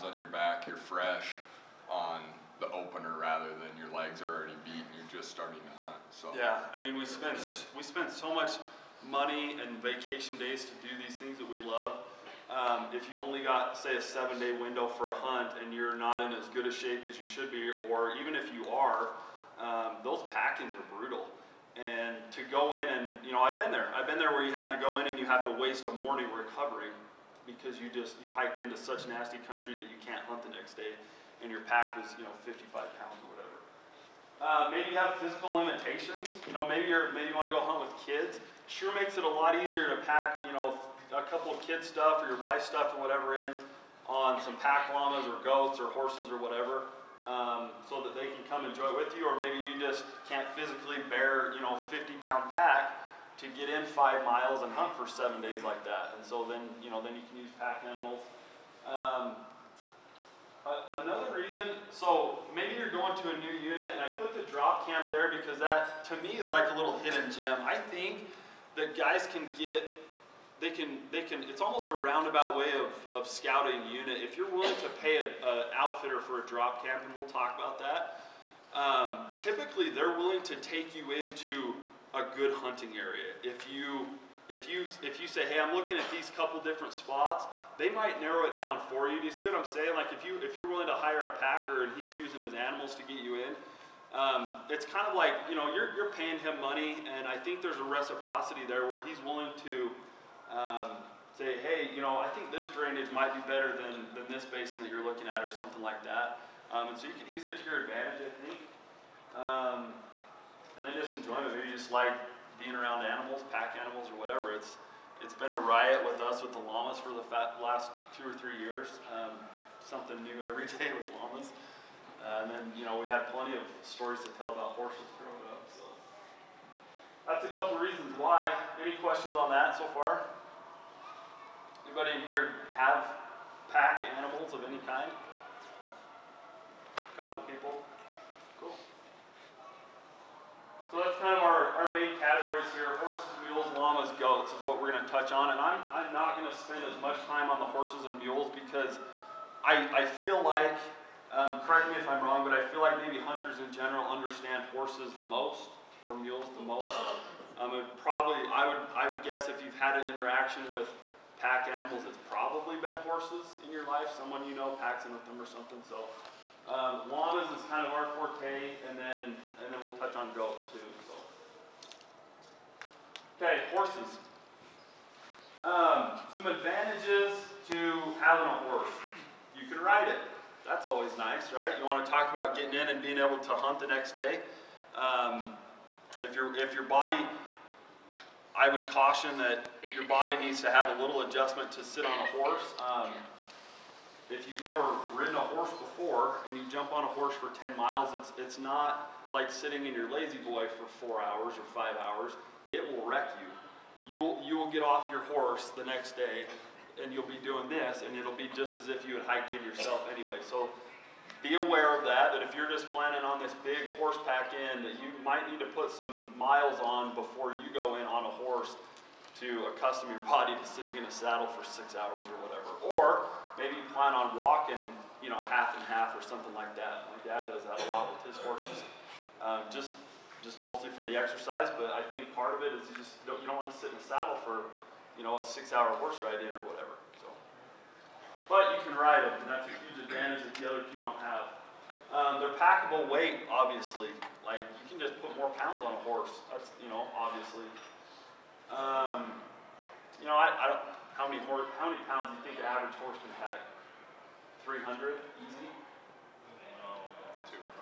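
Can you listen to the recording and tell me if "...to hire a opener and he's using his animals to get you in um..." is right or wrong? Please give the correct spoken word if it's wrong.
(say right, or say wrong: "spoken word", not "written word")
wrong: "packer", not "opener".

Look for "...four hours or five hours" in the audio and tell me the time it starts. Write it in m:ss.
3:21.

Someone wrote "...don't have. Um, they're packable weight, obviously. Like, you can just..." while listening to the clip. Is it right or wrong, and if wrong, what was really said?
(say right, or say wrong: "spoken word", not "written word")
right.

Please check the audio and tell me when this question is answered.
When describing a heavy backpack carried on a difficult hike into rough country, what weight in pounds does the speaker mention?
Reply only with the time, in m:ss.
0:32.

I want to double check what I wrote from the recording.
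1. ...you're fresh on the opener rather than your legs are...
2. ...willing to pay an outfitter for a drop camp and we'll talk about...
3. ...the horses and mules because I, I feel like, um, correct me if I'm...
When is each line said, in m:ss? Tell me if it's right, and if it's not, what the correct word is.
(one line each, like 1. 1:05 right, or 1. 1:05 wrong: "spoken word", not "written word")
1. 0:00 right
2. 1:14 right
3. 2:27 right.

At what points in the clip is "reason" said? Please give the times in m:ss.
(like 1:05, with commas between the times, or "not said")
1:01, 2:07.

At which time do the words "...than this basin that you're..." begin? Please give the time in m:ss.
1:44.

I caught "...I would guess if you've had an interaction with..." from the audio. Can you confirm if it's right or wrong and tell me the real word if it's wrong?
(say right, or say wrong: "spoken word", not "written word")
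right.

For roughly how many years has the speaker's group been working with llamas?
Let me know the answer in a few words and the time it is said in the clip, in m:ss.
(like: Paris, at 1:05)
2 or 3 years, at 1:58.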